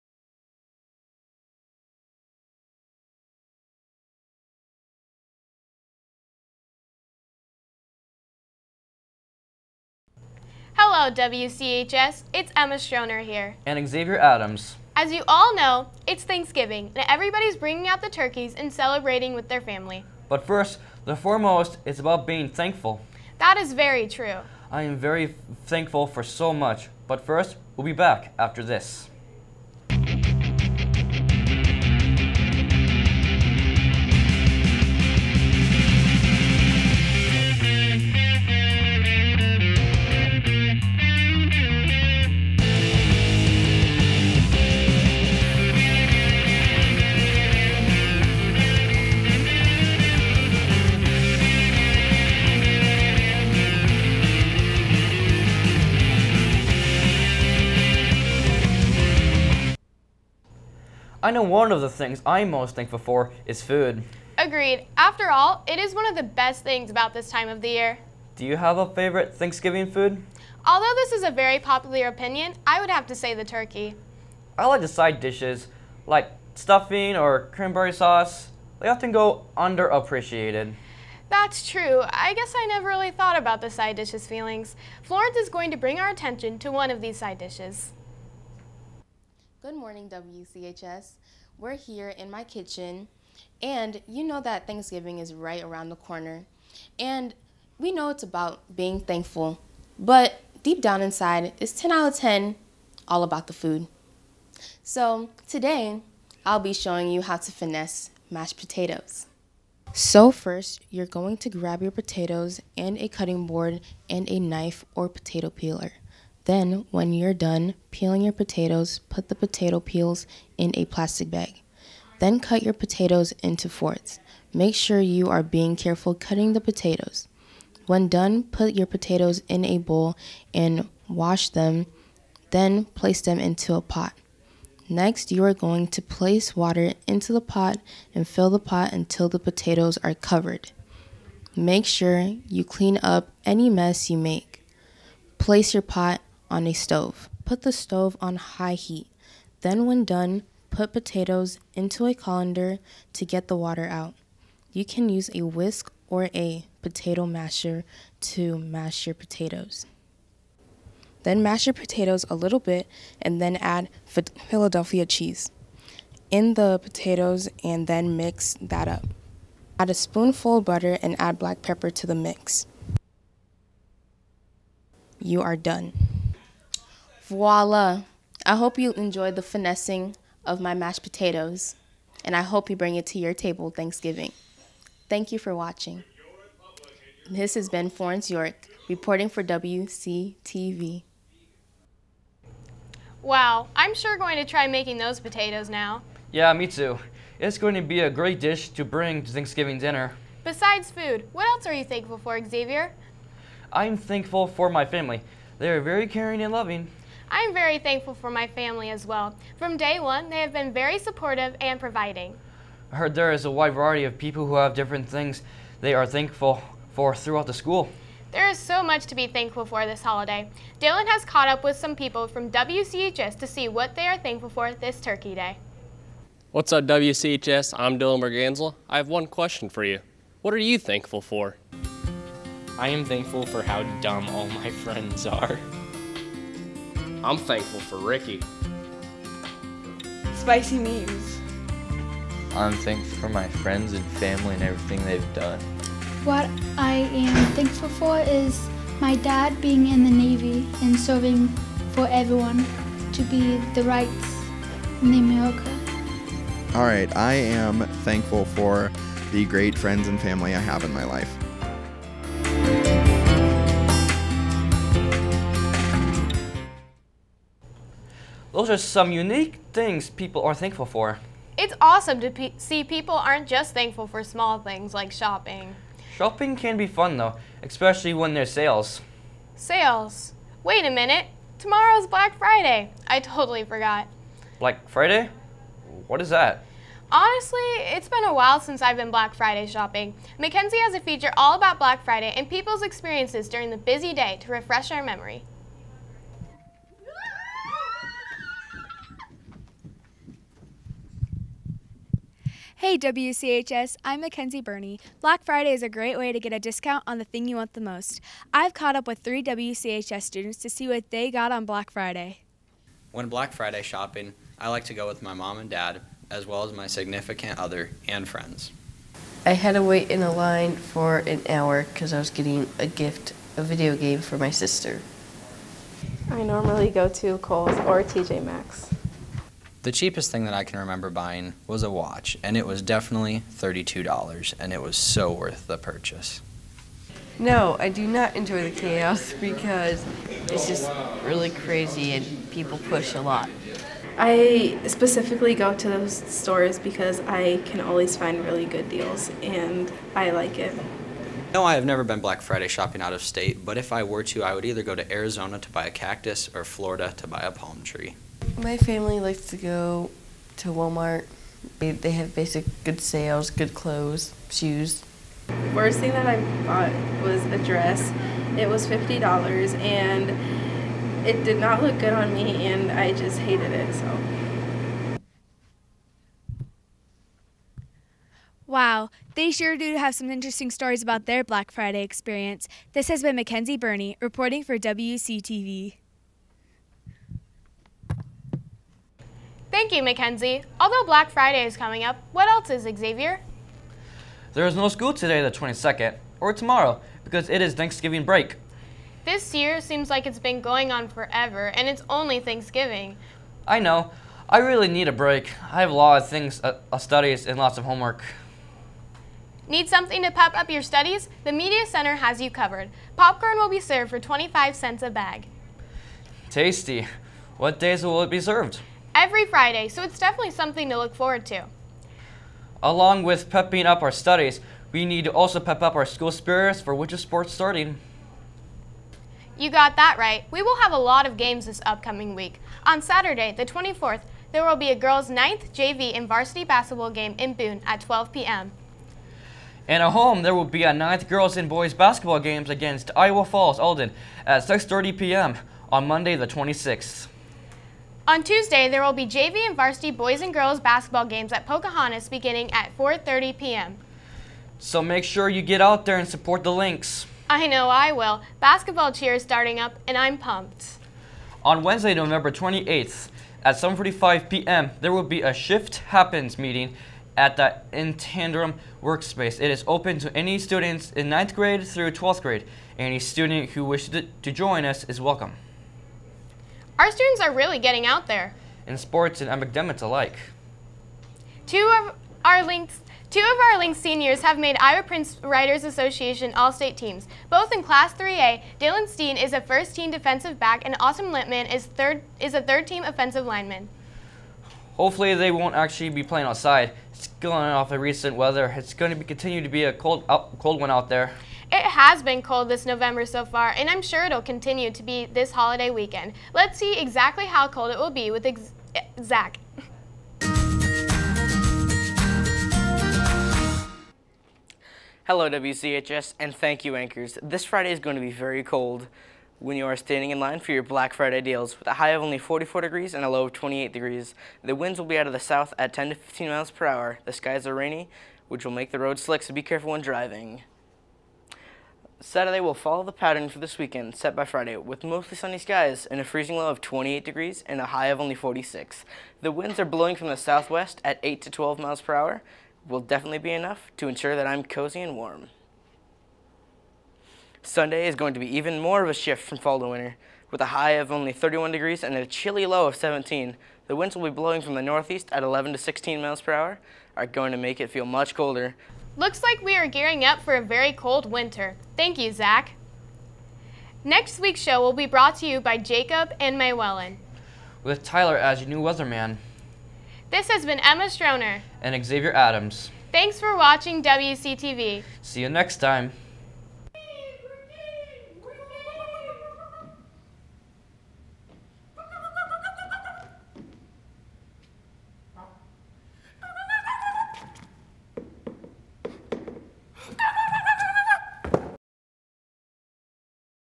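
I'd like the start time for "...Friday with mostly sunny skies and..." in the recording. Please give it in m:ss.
8:54.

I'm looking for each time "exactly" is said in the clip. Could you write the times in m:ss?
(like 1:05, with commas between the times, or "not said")
8:26.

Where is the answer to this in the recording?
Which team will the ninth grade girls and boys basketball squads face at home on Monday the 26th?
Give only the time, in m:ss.
7:23.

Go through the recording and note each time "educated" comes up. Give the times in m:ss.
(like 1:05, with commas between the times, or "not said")
not said.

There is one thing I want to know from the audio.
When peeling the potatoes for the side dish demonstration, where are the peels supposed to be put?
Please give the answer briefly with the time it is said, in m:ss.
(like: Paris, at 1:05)
plastic bag, at 2:00.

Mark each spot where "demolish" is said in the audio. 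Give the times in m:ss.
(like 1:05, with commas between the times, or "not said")
not said.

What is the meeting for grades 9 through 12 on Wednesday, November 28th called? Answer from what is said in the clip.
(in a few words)
Shift Happens.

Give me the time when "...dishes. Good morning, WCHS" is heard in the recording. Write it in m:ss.
1:27.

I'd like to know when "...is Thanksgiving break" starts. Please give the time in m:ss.
6:37.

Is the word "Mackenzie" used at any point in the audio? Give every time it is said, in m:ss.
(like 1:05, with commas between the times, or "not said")
4:50, 5:04, 6:23, 6:30.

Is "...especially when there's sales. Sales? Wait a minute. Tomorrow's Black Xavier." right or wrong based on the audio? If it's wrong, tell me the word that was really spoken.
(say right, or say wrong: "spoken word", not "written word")
wrong: "Friday", not "Xavier".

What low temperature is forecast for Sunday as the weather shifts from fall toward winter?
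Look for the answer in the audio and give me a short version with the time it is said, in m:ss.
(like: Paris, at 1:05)
17 degrees, at 9:12.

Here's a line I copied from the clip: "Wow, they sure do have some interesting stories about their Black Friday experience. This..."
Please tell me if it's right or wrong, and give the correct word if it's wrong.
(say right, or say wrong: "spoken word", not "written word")
right.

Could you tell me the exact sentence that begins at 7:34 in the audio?
So make sure you get out there and support the Lynx.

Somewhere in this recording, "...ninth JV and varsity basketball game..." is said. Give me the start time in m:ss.
7:15.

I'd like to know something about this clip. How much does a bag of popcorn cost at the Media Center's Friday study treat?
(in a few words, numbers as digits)
25 cents.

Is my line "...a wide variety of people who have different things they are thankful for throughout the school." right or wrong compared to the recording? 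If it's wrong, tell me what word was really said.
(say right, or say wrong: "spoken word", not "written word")
right.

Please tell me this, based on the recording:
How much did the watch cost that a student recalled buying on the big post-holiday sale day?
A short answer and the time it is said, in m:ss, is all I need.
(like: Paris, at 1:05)
$32, at 5:33.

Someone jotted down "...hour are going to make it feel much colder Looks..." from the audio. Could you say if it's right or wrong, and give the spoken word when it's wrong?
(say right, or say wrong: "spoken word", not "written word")
right.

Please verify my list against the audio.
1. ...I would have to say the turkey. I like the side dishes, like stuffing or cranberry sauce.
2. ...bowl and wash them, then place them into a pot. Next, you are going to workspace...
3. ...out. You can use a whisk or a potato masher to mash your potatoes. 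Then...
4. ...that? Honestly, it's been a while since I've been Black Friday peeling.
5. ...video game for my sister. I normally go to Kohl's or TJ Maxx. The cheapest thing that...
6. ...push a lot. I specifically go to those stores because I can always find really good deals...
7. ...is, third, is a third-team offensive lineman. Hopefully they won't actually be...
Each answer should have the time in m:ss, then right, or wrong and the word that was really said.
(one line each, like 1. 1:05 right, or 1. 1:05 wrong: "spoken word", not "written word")
1. 1:12 right
2. 2:09 wrong: "place", not "workspace"
3. 2:33 right
4. 4:46 wrong: "shopping", not "peeling"
5. 5:23 right
6. 5:42 right
7. 8:11 right.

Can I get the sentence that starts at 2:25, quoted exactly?
Place your pot on a stove.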